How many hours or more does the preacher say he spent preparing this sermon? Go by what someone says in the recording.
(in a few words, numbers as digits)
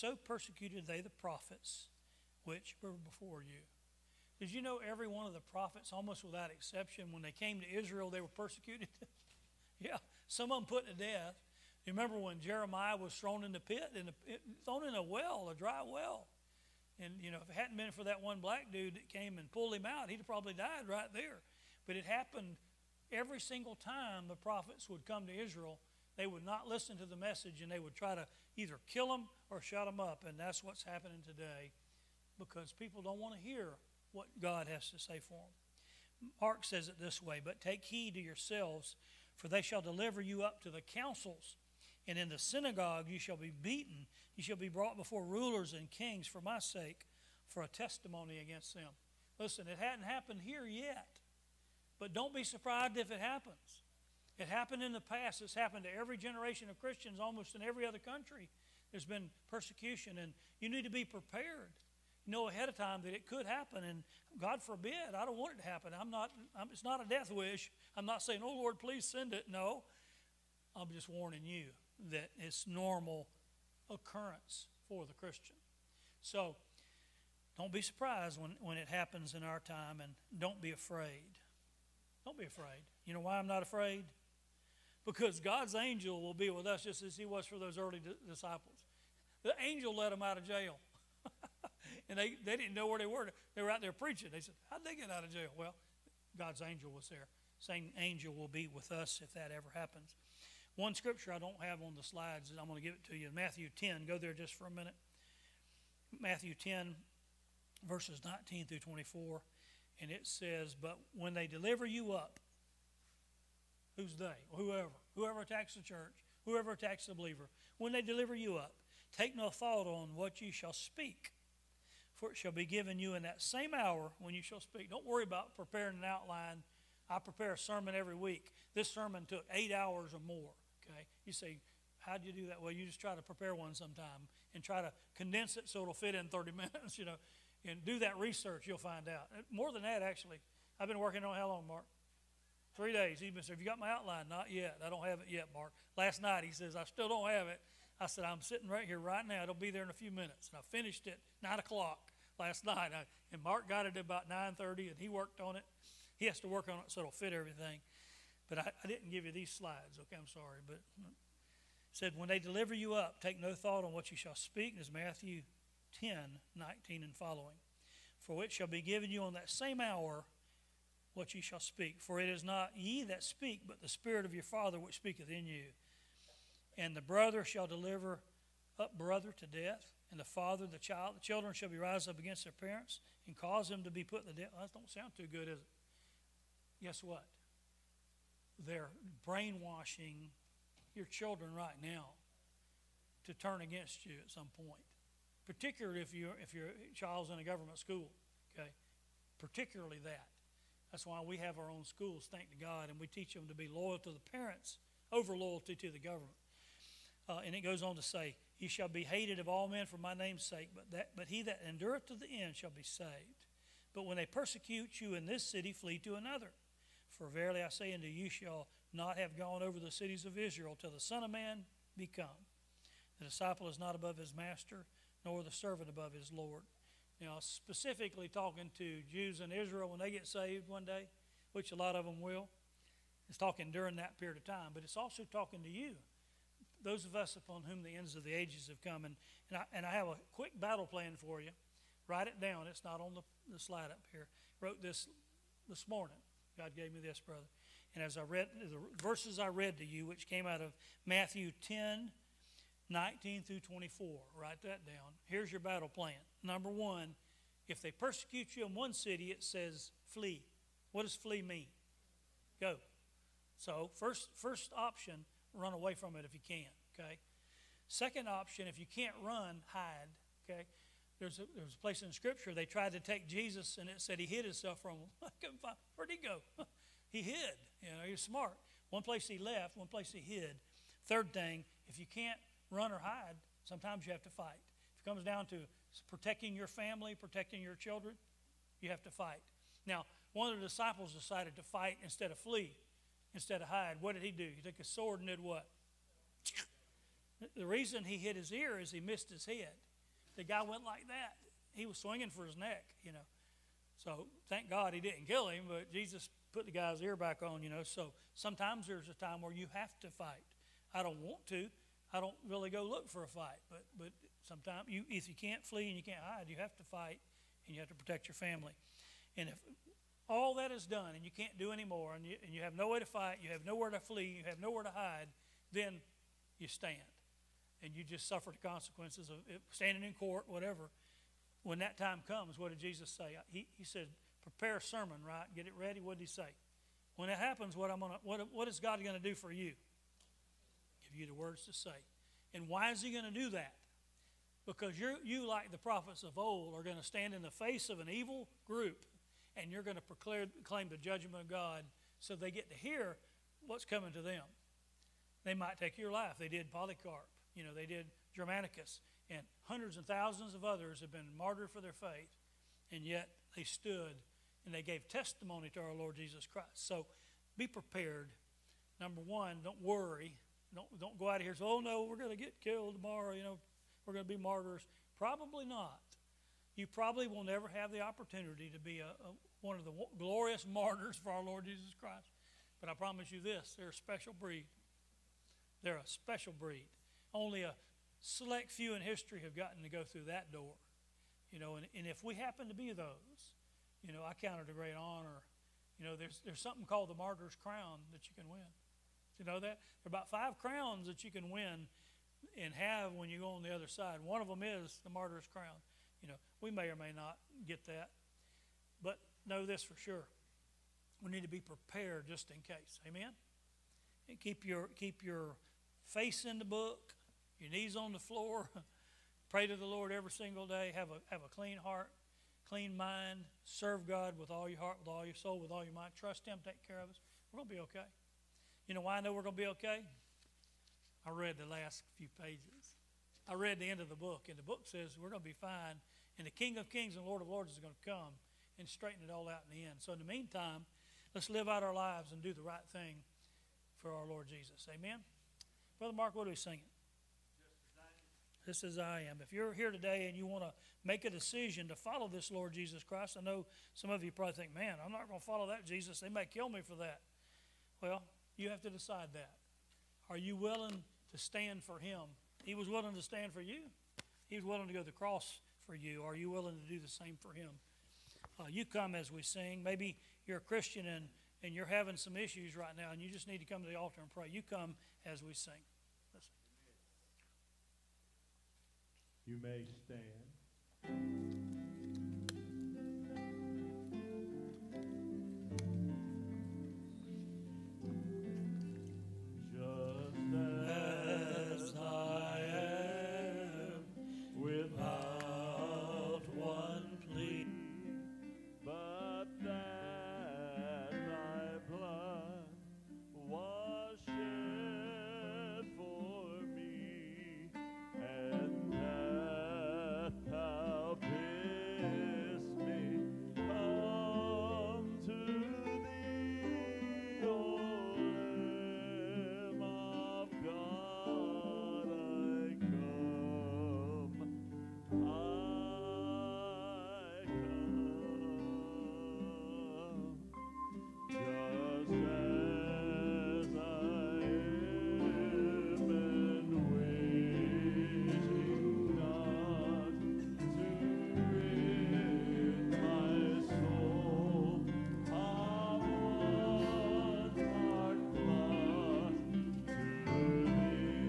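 8.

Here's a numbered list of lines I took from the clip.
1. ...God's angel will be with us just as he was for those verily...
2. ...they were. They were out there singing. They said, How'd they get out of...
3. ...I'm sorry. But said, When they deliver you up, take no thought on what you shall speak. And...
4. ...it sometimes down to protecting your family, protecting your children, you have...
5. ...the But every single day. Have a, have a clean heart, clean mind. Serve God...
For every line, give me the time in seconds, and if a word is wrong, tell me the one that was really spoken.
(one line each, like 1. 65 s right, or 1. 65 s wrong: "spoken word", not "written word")
1. 85 s wrong: "early", not "verily"
2. 92 s wrong: "preaching", not "singing"
3. 160 s right
4. 285 s wrong: "comes", not "sometimes"
5. 419 s wrong: "Lord", not "But".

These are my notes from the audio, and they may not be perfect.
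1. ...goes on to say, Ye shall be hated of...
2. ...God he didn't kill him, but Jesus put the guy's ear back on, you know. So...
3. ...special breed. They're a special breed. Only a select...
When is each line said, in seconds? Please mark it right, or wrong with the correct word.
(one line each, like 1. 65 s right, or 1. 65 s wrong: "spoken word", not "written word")
1. 207 s right
2. 304 s right
3. 383 s right.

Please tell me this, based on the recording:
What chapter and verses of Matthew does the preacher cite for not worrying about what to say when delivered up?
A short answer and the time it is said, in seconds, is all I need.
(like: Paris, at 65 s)
Matthew 10:19-24, at 106 s.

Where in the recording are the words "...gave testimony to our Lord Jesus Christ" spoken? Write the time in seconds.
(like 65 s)
364 s.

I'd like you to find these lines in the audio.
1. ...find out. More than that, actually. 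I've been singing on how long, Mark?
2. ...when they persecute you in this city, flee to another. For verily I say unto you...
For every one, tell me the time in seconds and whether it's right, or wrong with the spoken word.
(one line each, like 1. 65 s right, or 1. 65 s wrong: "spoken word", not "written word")
1. 138 s wrong: "working", not "singing"
2. 214 s right.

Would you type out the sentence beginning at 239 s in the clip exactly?
And, and, I, and I have a quick battle plan for you.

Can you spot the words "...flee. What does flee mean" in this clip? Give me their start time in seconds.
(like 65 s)
260 s.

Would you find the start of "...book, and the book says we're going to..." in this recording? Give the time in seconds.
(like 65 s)
434 s.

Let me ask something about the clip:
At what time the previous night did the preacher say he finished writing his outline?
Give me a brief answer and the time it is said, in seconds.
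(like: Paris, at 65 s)
9 o'clock, at 151 s.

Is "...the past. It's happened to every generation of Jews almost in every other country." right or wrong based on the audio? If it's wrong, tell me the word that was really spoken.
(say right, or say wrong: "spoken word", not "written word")
wrong: "Christians", not "Jews".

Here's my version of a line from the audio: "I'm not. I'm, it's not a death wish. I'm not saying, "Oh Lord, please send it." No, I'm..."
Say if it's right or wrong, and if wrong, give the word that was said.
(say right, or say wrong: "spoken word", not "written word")
right.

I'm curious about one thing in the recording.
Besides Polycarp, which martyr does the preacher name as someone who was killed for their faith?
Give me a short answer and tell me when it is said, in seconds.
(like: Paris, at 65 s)
Germanicus, at 358 s.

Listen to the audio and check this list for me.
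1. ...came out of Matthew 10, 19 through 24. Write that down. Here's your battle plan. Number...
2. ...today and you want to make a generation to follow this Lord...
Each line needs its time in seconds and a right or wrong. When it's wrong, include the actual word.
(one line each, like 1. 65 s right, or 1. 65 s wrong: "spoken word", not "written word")
1. 250 s right
2. 449 s wrong: "decision", not "generation".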